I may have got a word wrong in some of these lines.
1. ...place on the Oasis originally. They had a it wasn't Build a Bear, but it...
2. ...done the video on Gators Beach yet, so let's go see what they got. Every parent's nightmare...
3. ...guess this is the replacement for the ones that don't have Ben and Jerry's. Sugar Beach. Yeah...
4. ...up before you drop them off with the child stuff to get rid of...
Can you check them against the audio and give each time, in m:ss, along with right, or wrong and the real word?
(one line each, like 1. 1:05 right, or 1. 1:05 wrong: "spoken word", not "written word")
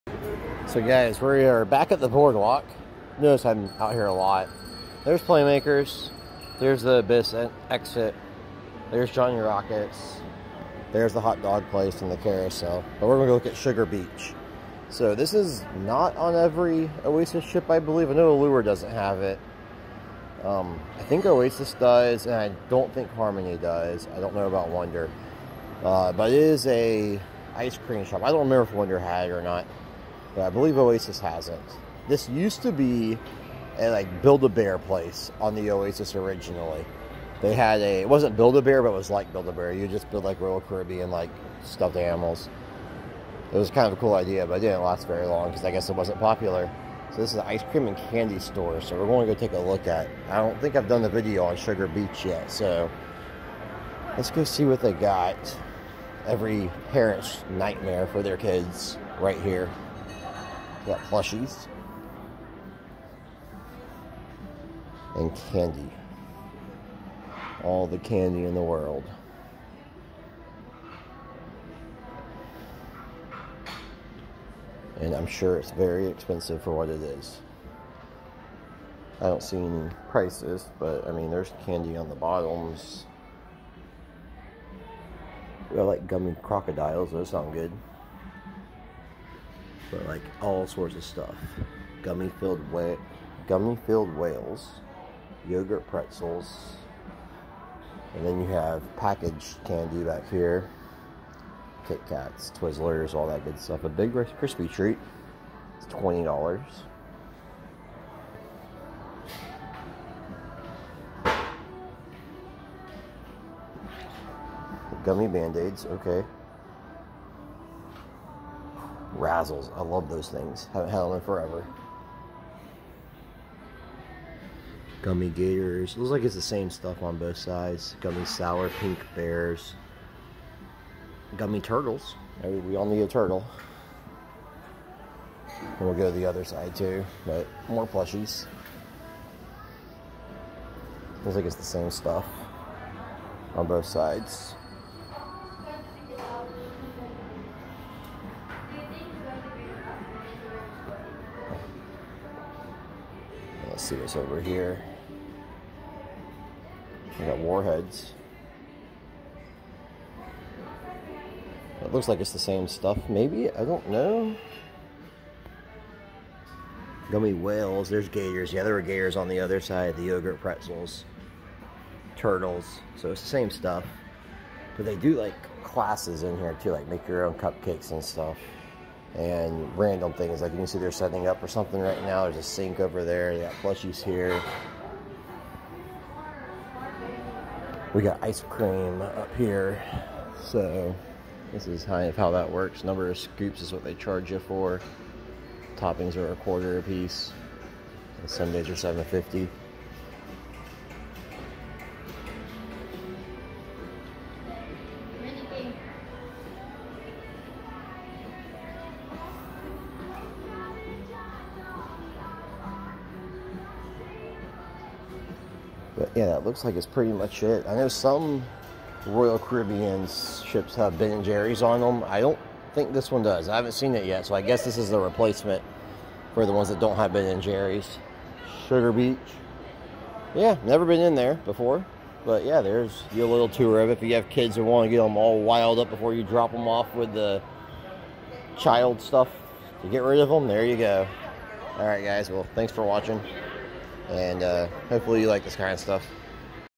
1. 0:34 right
2. 0:50 wrong: "Sugar", not "Gators"
3. 3:44 right
4. 3:55 right.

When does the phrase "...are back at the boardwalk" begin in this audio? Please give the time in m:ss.
0:01.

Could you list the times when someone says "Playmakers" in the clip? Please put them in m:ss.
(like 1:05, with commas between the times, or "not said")
0:05.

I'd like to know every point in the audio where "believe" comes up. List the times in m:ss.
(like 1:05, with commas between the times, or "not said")
0:17, 0:30.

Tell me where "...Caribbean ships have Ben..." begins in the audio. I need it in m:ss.
3:39.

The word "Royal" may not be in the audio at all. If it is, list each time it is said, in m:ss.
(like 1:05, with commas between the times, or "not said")
0:40, 3:39.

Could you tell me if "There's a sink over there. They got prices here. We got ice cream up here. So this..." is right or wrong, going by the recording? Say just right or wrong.
wrong.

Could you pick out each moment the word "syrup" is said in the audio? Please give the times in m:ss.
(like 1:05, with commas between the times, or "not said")
not said.